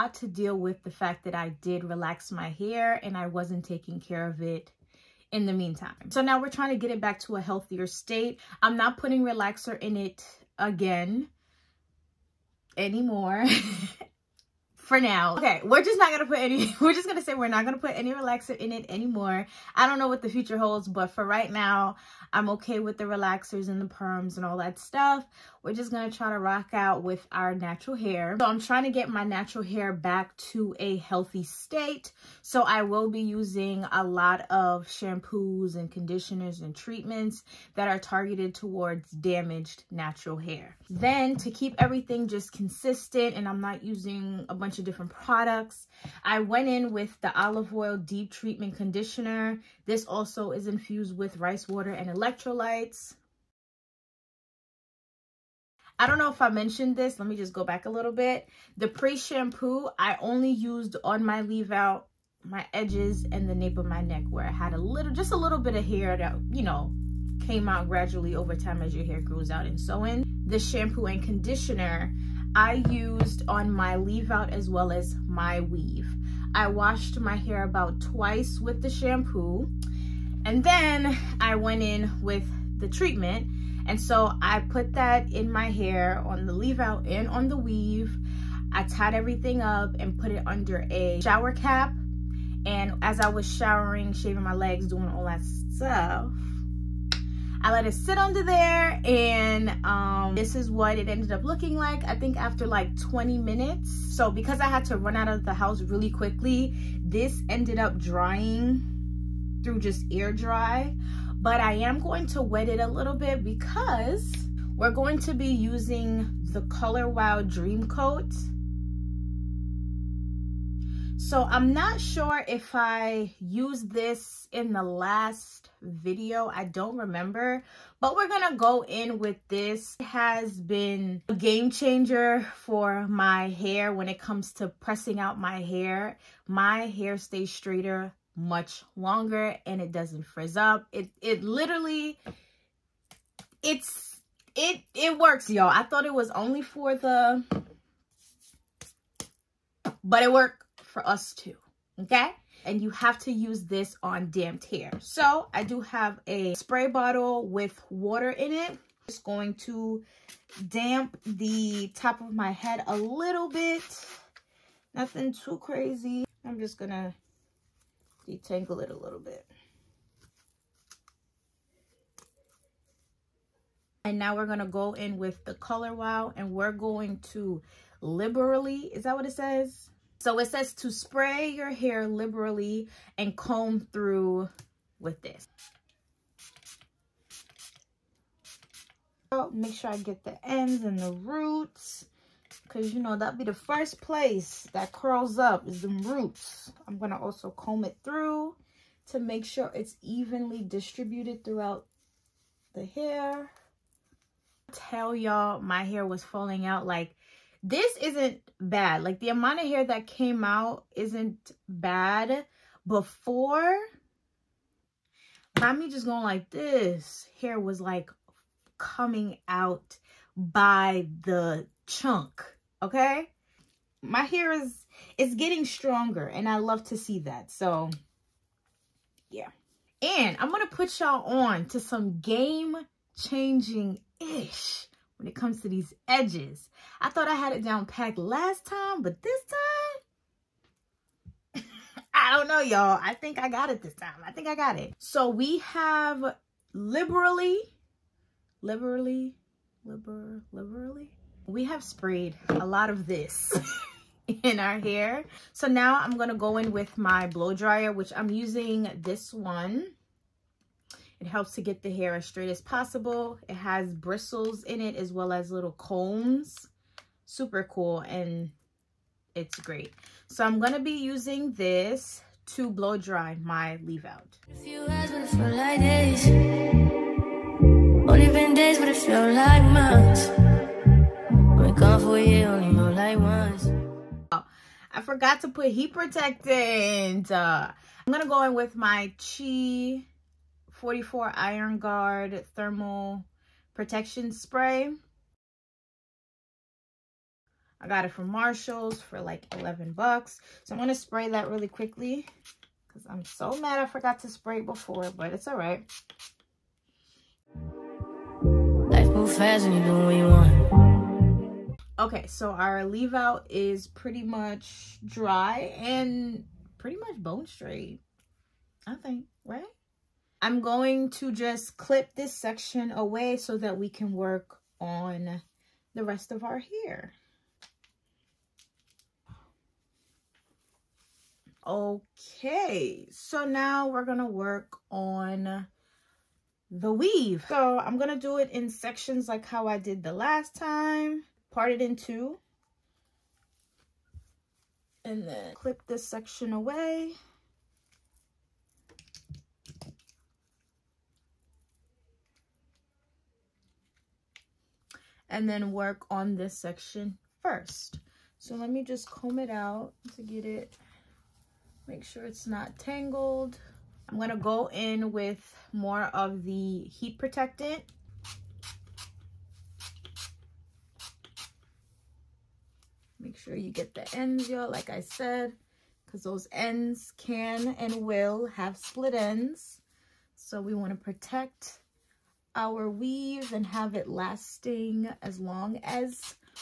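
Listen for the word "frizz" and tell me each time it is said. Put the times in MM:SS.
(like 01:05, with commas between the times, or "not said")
02:20.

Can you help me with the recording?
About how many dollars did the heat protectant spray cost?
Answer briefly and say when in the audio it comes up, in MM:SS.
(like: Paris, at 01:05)
11, at 04:59.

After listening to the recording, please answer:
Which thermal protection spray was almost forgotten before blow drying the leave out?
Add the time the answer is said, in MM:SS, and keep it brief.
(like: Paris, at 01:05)
Chi 44 Iron Guard, at 04:49.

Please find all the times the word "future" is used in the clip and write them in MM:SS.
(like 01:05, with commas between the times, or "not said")
00:20.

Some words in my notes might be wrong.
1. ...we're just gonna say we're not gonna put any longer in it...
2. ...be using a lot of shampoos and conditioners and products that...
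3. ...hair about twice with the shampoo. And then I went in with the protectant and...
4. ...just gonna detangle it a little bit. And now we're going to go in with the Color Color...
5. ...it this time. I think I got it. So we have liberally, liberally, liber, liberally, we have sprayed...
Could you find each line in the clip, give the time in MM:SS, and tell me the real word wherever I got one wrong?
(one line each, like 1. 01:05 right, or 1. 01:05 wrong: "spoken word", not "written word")
1. 00:16 wrong: "relaxer", not "longer"
2. 00:33 wrong: "treatments", not "products"
3. 01:17 wrong: "treatment", not "protectant"
4. 02:46 wrong: "Wow", not "Color"
5. 04:03 right.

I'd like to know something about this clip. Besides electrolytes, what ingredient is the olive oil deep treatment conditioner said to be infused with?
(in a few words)
rice water.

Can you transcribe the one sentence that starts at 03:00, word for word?
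So it says to spray your hair liberally and comb through with this.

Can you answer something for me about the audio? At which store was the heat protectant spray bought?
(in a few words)
Marshalls.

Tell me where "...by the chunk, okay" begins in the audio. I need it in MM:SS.
03:40.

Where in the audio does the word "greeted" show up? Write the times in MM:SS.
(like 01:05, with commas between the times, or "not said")
not said.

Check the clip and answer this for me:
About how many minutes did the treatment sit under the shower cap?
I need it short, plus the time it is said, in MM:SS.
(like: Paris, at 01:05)
20, at 01:42.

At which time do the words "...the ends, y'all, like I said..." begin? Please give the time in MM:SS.
06:13.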